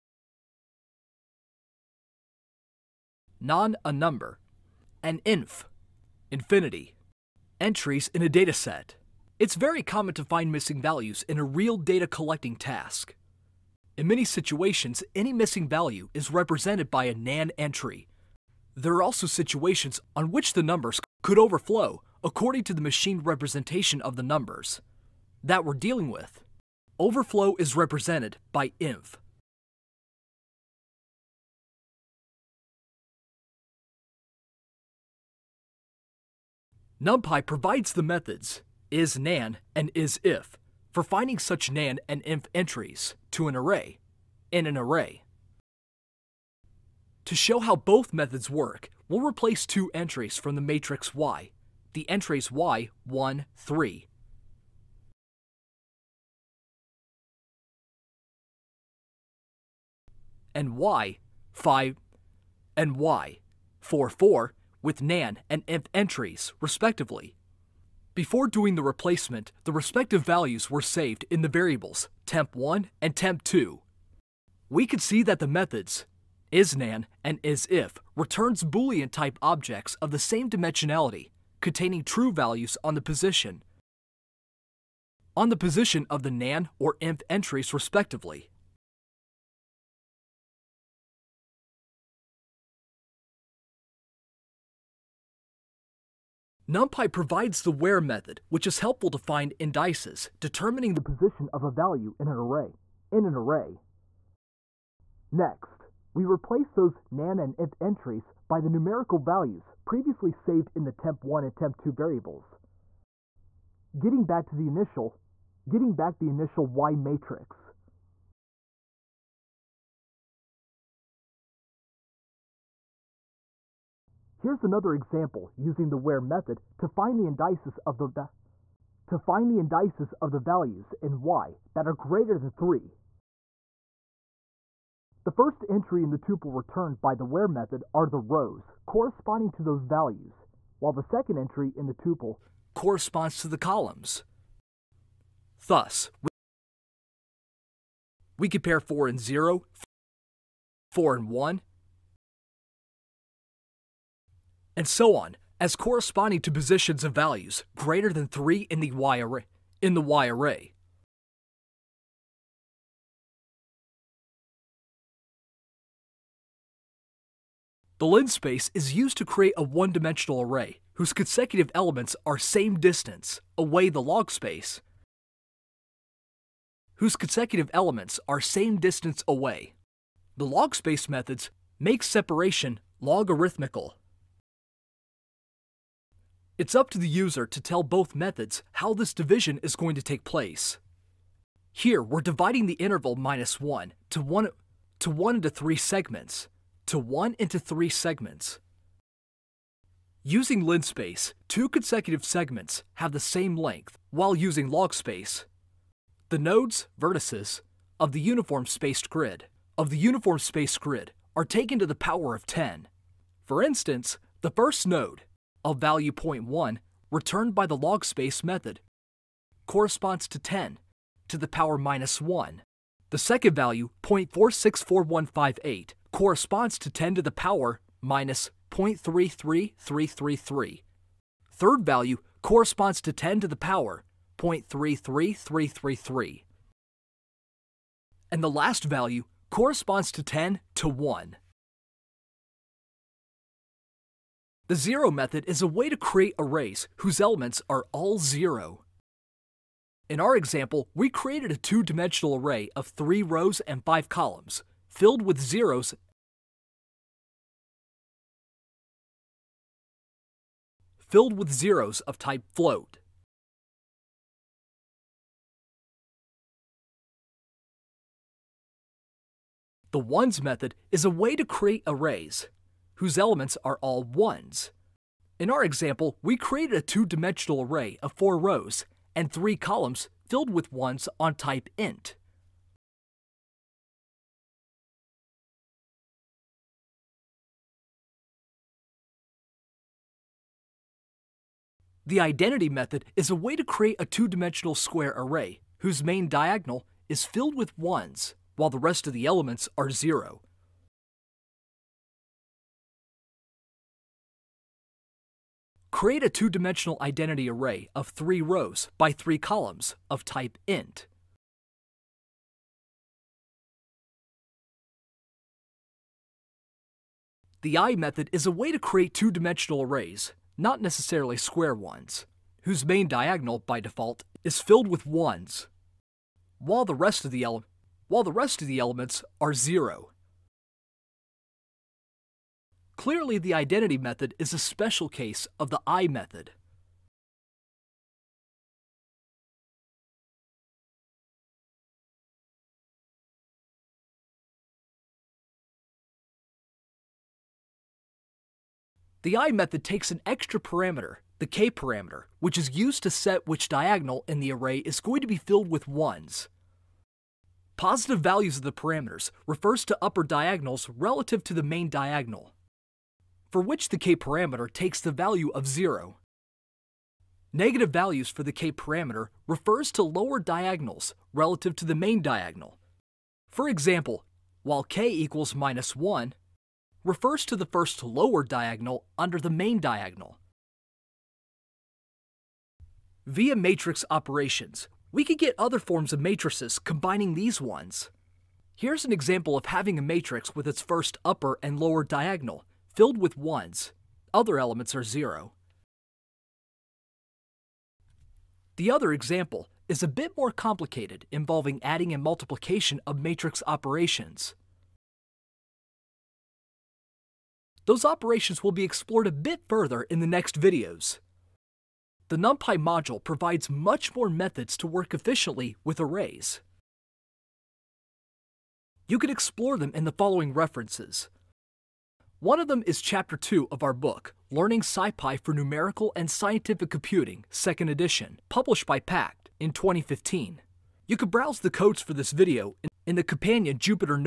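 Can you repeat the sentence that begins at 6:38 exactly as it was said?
The other example is a bit more complicated, involving adding and multiplication of matrix operations.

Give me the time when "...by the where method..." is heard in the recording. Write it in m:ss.
2:17.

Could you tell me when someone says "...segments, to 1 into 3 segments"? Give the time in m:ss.
3:15.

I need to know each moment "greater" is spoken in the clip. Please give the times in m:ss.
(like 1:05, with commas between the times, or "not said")
2:11, 2:37.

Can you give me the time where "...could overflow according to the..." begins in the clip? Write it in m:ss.
0:21.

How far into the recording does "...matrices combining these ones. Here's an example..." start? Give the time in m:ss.
6:26.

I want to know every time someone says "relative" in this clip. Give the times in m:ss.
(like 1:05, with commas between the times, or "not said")
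6:00, 6:11.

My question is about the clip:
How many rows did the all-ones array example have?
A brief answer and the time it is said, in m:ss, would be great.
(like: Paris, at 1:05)
4, at 4:38.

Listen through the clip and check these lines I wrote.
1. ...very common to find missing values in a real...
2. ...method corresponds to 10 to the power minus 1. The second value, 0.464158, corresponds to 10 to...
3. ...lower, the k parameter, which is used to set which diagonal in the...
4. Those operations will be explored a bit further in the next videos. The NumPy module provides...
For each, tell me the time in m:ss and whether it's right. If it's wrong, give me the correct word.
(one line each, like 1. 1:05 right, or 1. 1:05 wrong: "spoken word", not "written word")
1. 0:09 right
2. 3:38 right
3. 5:50 wrong: "parameter", not "lower"
4. 6:47 right.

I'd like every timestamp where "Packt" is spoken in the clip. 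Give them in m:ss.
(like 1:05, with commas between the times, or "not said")
7:09.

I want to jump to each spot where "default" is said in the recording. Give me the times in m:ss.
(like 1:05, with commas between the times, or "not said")
5:23.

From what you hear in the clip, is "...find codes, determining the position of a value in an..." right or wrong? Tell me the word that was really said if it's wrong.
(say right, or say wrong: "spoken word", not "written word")
wrong: "indices", not "codes".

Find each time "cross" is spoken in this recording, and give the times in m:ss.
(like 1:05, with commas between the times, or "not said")
not said.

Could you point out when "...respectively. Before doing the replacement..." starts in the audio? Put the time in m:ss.
1:06.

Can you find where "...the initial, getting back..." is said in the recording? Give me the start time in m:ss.
1:54.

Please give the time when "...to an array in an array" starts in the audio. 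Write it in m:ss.
0:43.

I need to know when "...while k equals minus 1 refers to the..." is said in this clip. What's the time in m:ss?
6:14.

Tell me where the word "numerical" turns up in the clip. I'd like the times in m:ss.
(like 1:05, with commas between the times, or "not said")
1:48, 7:05.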